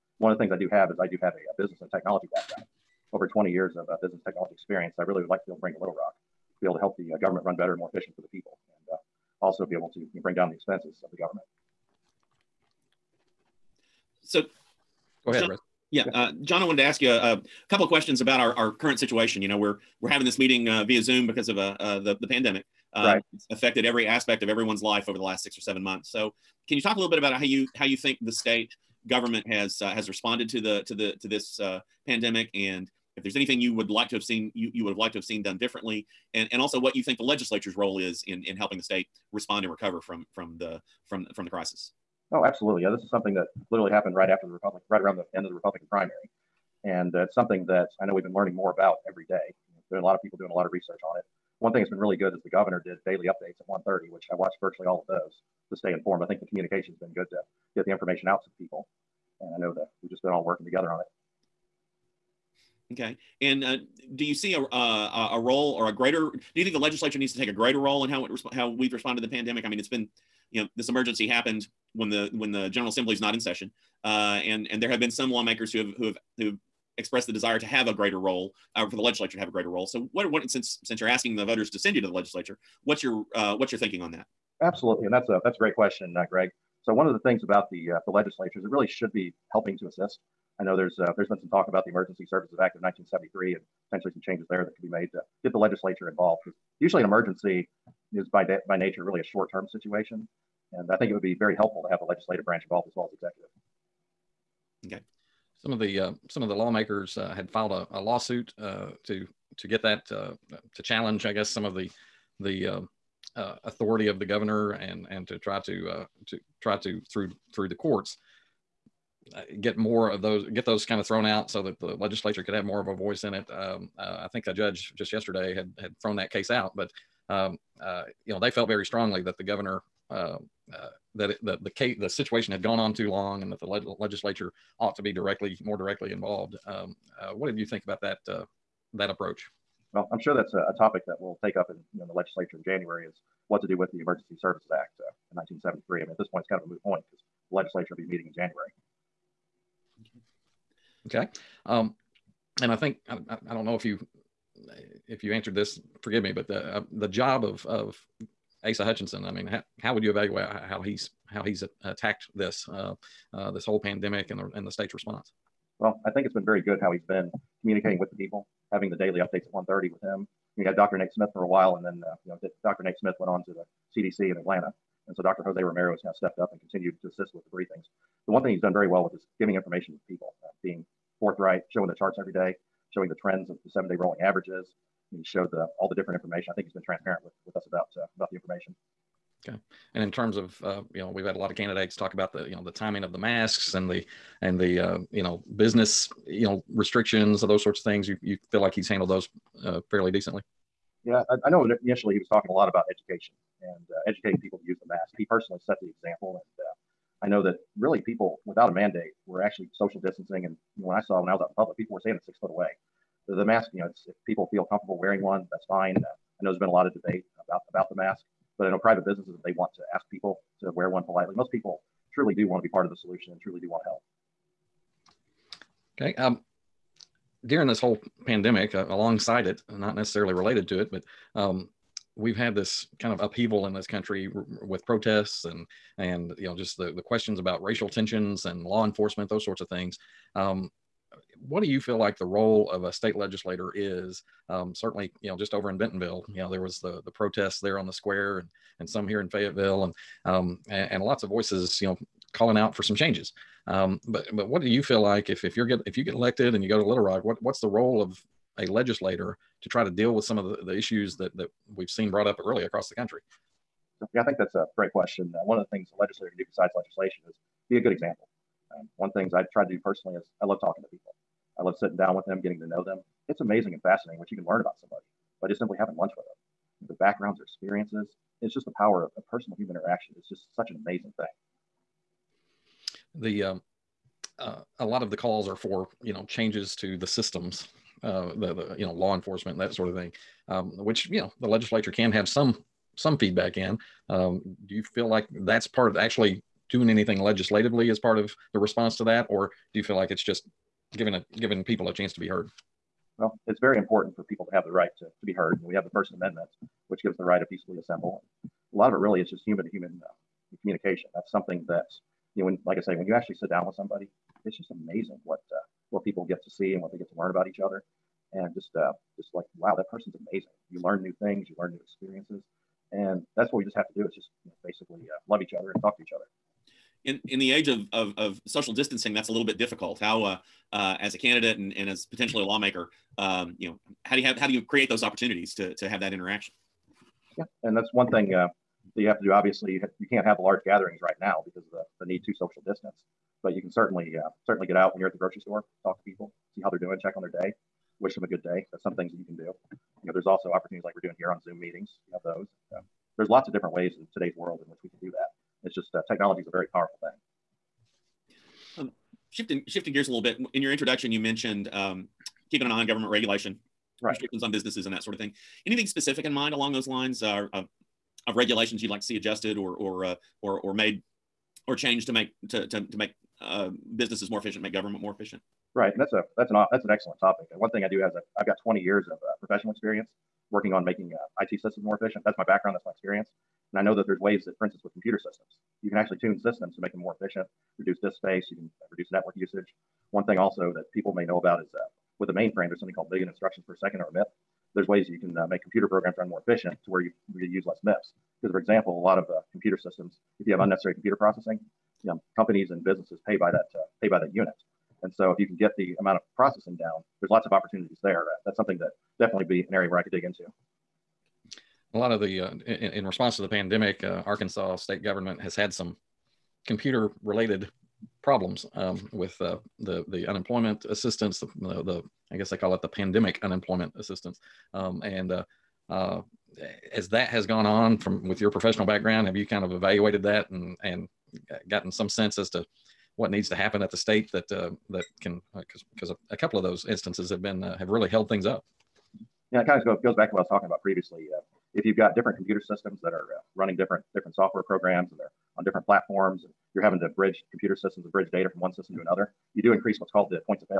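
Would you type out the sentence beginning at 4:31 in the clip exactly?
I love sitting down with them, getting to know them.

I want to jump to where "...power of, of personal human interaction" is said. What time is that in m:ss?
4:38.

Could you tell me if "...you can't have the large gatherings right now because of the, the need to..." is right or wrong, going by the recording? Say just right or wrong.
right.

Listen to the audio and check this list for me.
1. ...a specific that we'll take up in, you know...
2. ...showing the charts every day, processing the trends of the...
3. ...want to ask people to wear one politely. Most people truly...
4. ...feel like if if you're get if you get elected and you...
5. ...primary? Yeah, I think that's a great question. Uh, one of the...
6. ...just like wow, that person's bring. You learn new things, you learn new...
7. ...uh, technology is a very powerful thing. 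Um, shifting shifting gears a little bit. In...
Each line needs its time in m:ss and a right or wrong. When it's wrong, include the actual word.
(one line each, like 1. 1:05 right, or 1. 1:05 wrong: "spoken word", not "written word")
1. 2:20 wrong: "topic", not "specific"
2. 3:01 wrong: "showing", not "processing"
3. 3:39 right
4. 4:14 right
5. 4:22 wrong: "country", not "primary"
6. 5:19 wrong: "amazing", not "bring"
7. 5:55 right.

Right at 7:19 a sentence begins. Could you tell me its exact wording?
Yeah, it kind of goes, goes back to what I was talking about previously.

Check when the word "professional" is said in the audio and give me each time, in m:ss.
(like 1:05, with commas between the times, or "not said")
6:19, 7:08.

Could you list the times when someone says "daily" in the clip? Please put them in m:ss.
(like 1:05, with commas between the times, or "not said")
0:53, 2:48.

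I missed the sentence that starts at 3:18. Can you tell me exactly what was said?
You, you feel like he's handled those uh, fairly decently?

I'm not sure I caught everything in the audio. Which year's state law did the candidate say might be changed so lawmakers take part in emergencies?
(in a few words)
1973.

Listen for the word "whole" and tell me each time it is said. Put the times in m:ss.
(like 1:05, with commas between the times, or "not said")
2:43, 3:47.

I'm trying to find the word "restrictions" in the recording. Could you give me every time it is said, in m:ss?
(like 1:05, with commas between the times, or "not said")
3:16, 6:04.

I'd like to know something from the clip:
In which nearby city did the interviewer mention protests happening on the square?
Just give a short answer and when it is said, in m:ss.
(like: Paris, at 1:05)
Bentonville, at 4:05.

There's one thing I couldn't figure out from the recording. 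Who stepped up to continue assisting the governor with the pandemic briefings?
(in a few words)
Dr. Jose Romero.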